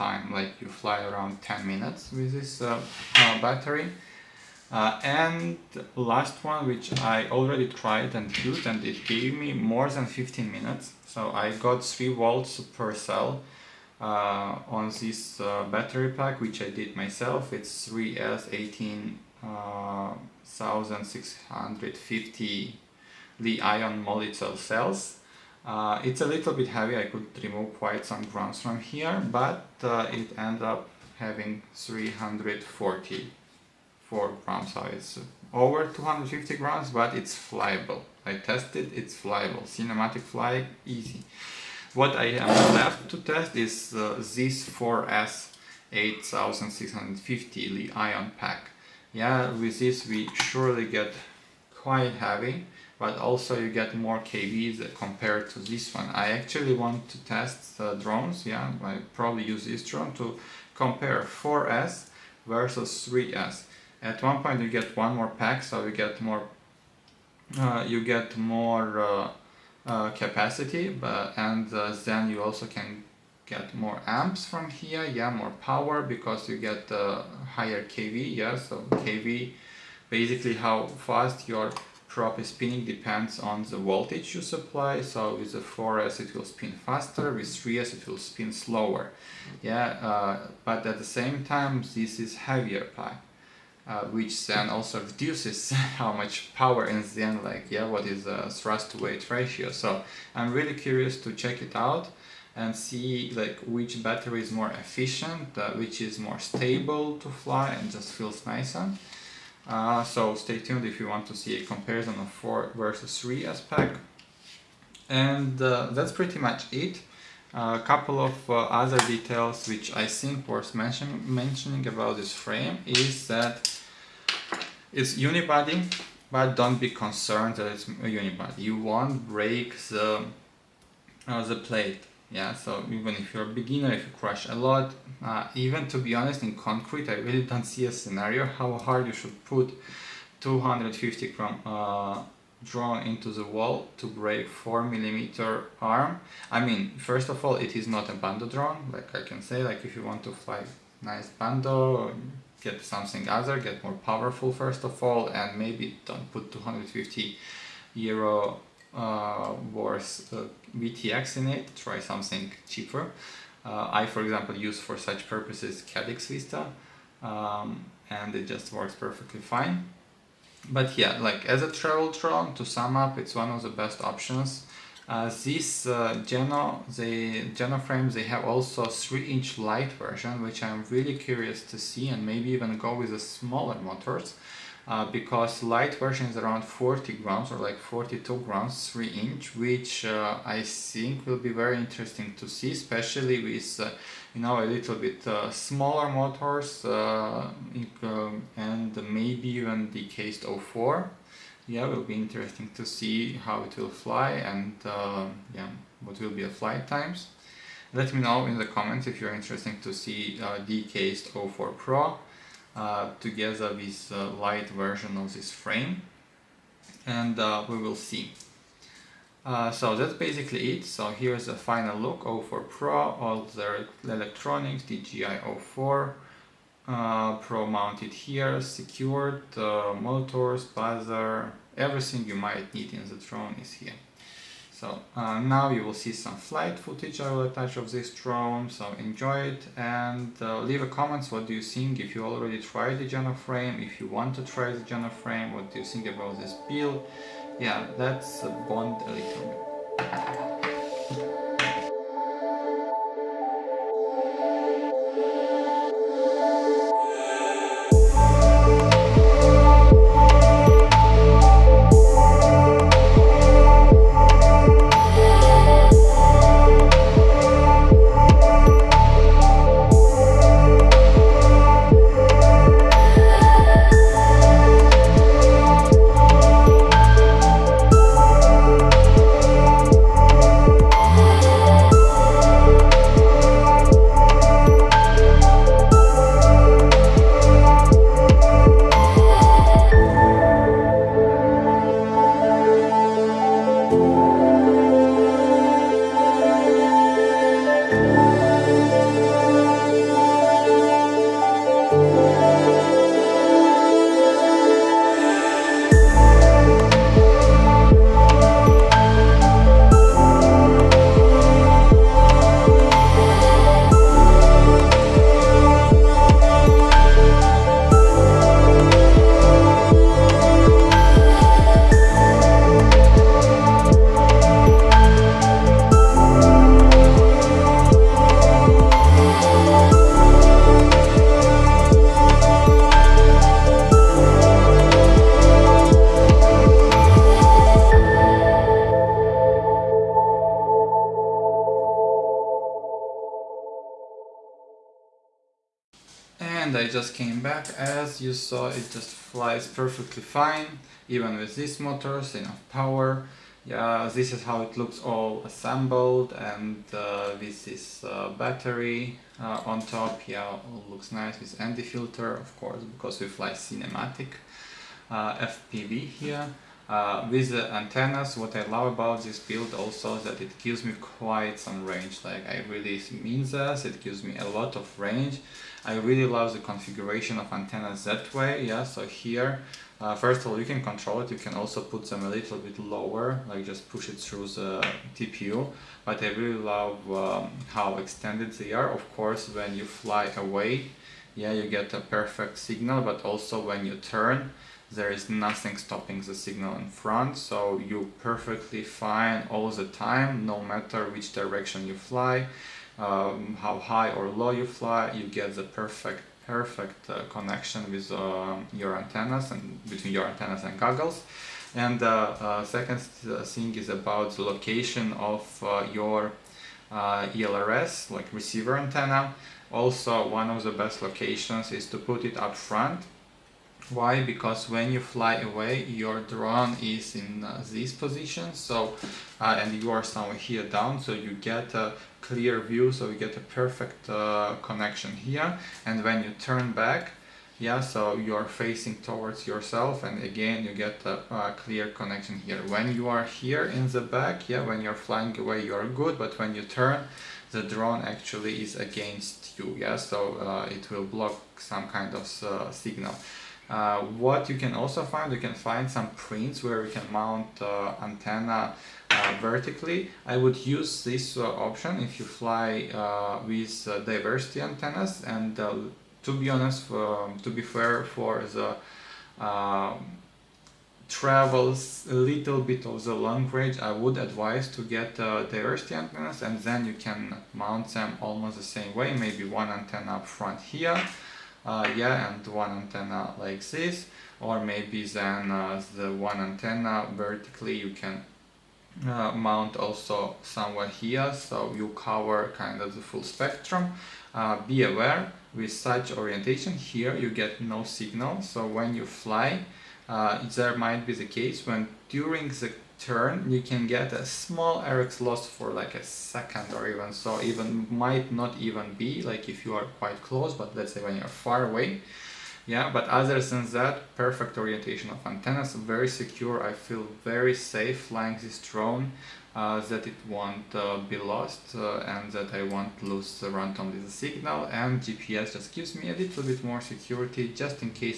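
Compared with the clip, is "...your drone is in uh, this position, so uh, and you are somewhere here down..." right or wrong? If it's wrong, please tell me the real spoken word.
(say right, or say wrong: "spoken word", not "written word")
right.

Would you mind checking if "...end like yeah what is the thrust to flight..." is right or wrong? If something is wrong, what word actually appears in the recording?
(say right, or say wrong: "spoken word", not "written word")
wrong: "weight", not "flight".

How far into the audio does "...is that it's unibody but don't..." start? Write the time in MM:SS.
02:02.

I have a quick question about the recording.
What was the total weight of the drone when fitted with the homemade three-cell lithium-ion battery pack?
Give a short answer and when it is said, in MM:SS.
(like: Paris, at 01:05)
344 grams, at 00:31.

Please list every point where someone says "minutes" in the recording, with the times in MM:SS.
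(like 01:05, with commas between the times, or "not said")
00:01, 00:10.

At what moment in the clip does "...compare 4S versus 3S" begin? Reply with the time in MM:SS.
01:00.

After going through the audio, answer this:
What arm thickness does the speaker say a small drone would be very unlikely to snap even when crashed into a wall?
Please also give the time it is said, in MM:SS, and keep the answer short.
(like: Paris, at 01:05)
4 millimeters, at 02:24.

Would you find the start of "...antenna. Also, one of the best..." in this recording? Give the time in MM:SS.
06:58.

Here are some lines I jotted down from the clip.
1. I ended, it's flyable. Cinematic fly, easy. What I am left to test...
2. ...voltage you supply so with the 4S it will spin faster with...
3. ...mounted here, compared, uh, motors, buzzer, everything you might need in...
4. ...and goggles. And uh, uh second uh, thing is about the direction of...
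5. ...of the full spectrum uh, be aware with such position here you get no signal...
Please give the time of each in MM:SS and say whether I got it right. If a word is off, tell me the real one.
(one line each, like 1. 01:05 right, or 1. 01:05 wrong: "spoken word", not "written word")
1. 00:38 wrong: "tested", not "ended"
2. 01:23 right
3. 03:47 wrong: "secured", not "compared"
4. 06:50 wrong: "location", not "direction"
5. 08:12 wrong: "orientation", not "position".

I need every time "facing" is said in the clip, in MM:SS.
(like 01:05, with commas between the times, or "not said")
07:18.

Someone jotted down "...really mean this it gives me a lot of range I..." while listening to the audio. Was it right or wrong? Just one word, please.
right.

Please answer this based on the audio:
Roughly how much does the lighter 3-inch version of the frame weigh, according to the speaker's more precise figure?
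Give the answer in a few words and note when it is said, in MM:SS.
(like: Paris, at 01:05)
42 grams, at 03:07.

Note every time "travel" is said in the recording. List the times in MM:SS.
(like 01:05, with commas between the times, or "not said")
02:51, 07:51.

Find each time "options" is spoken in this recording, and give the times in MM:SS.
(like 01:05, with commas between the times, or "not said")
02:54, 07:41.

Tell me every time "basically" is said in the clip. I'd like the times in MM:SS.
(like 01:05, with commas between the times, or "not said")
01:20, 03:40.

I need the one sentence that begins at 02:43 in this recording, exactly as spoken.
Uh, I, for example, use for such purposes Caddx Vista, um, and it just works perfectly fine.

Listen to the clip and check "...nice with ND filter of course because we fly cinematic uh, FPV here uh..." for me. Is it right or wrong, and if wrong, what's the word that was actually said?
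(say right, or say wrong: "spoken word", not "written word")
right.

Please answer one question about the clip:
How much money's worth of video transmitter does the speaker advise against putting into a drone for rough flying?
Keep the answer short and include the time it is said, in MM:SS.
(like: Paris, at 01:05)
250 euros, at 02:36.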